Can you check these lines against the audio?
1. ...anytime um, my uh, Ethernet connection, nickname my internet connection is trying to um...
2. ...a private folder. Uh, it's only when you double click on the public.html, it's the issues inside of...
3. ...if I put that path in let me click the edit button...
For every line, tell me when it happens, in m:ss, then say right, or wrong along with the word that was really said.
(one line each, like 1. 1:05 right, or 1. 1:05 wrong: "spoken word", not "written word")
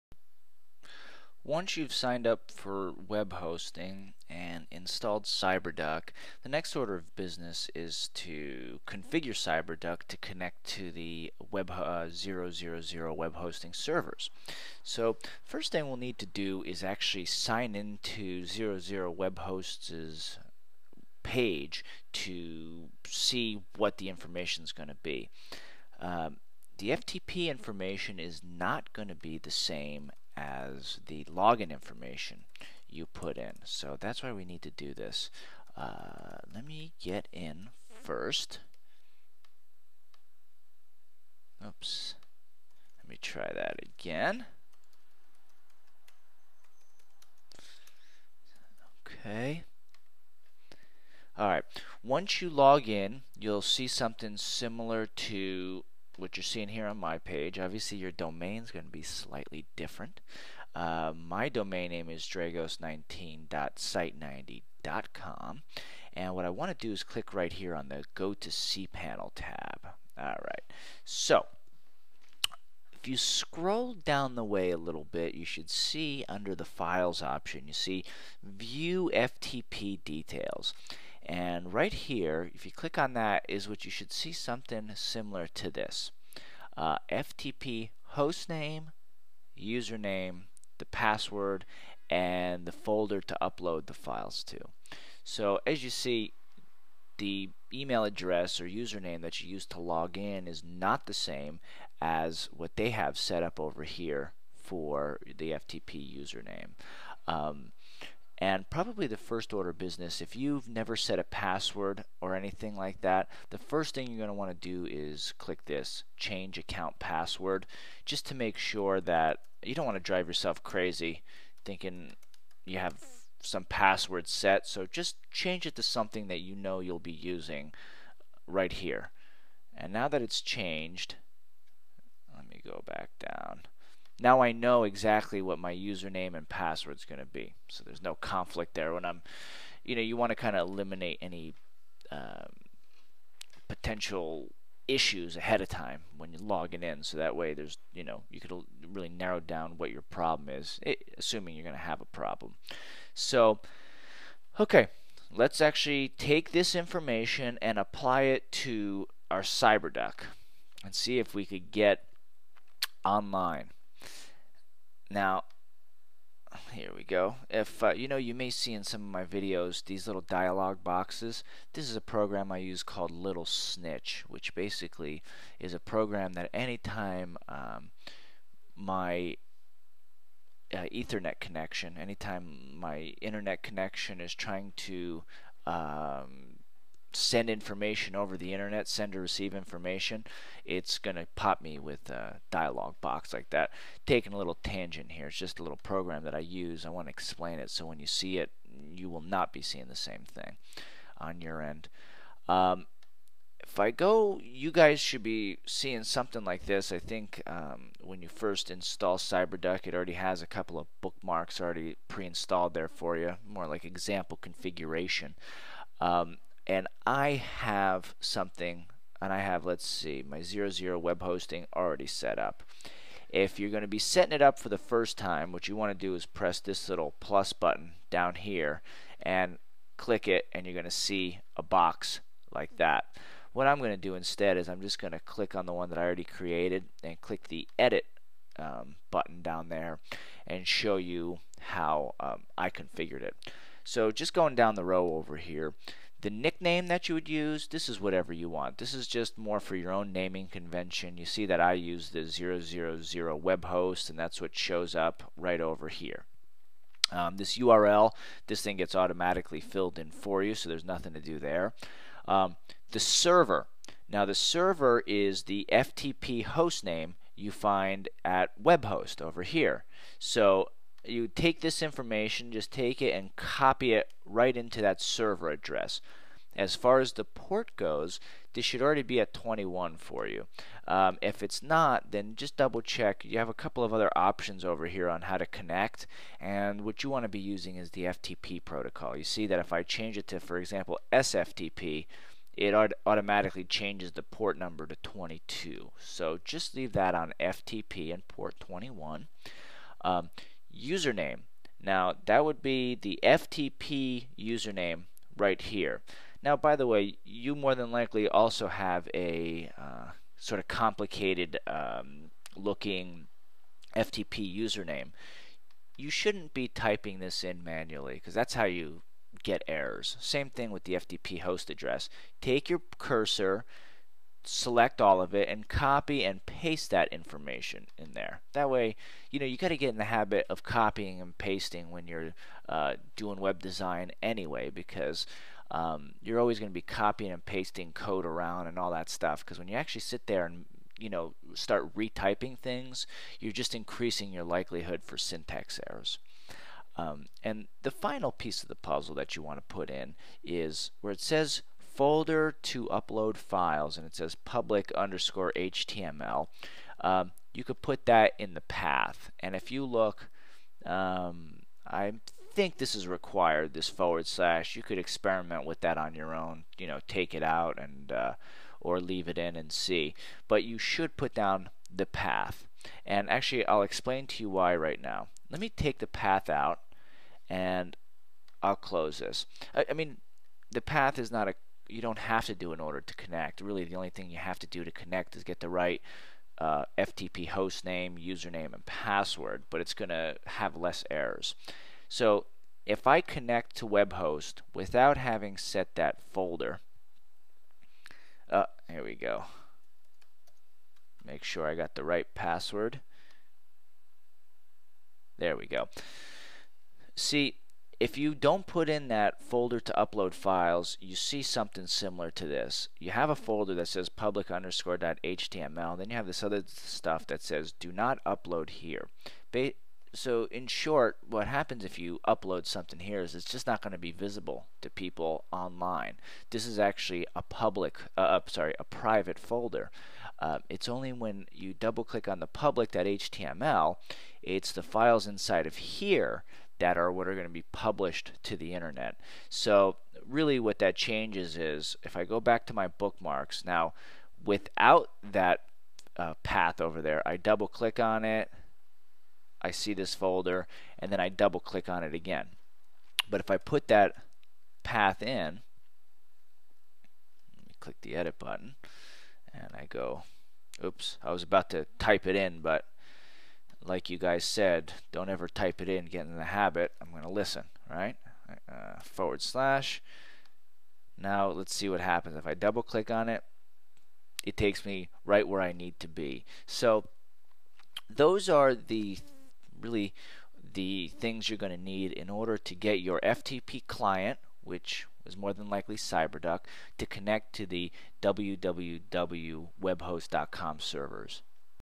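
1. 2:56 wrong: "anytime", not "nickname"
2. 7:08 wrong: "files", not "issues"
3. 7:33 right.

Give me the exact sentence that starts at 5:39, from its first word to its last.
Because when you actually sit there and you know start retyping things, you're just increasing your likelihood for syntax errors.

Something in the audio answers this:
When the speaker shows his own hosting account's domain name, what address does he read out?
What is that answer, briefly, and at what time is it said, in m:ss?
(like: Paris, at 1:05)
dragos19.site90.com, at 1:02.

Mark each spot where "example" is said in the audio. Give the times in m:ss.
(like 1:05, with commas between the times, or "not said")
3:33, 4:50.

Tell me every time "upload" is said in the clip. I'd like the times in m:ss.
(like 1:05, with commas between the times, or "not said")
1:33, 5:52, 6:49, 6:58, 7:02.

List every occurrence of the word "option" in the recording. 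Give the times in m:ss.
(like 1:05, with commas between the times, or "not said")
1:17, 4:44.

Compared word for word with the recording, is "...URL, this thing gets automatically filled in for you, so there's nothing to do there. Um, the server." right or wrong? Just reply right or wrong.
right.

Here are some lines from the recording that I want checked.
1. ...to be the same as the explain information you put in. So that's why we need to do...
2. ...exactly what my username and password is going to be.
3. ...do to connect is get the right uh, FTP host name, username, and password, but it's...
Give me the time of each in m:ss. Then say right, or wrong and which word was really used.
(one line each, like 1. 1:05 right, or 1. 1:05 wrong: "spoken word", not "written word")
1. 0:29 wrong: "login", not "explain"
2. 2:14 right
3. 6:24 right.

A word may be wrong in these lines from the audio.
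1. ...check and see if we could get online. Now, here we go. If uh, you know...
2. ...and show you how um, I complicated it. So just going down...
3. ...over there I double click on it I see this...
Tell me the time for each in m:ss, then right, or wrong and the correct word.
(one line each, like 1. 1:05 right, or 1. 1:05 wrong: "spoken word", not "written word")
1. 2:39 wrong: "cyberduck", not "check"
2. 4:00 wrong: "configured", not "complicated"
3. 7:26 right.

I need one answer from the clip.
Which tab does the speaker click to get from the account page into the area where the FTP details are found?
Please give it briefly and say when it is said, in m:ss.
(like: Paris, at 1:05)
Go to cPanel, at 1:08.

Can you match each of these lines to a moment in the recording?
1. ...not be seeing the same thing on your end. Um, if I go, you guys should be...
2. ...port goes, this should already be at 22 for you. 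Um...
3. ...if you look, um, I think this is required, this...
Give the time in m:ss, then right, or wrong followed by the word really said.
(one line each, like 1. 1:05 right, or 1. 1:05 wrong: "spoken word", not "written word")
1. 3:19 right
2. 4:37 wrong: "21", not "22"
3. 5:59 right.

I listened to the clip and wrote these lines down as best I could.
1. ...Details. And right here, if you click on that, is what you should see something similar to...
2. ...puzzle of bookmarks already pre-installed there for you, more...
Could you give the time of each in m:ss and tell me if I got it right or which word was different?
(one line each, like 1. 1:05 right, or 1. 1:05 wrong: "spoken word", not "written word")
1. 1:20 right
2. 3:30 wrong: "couple", not "puzzle".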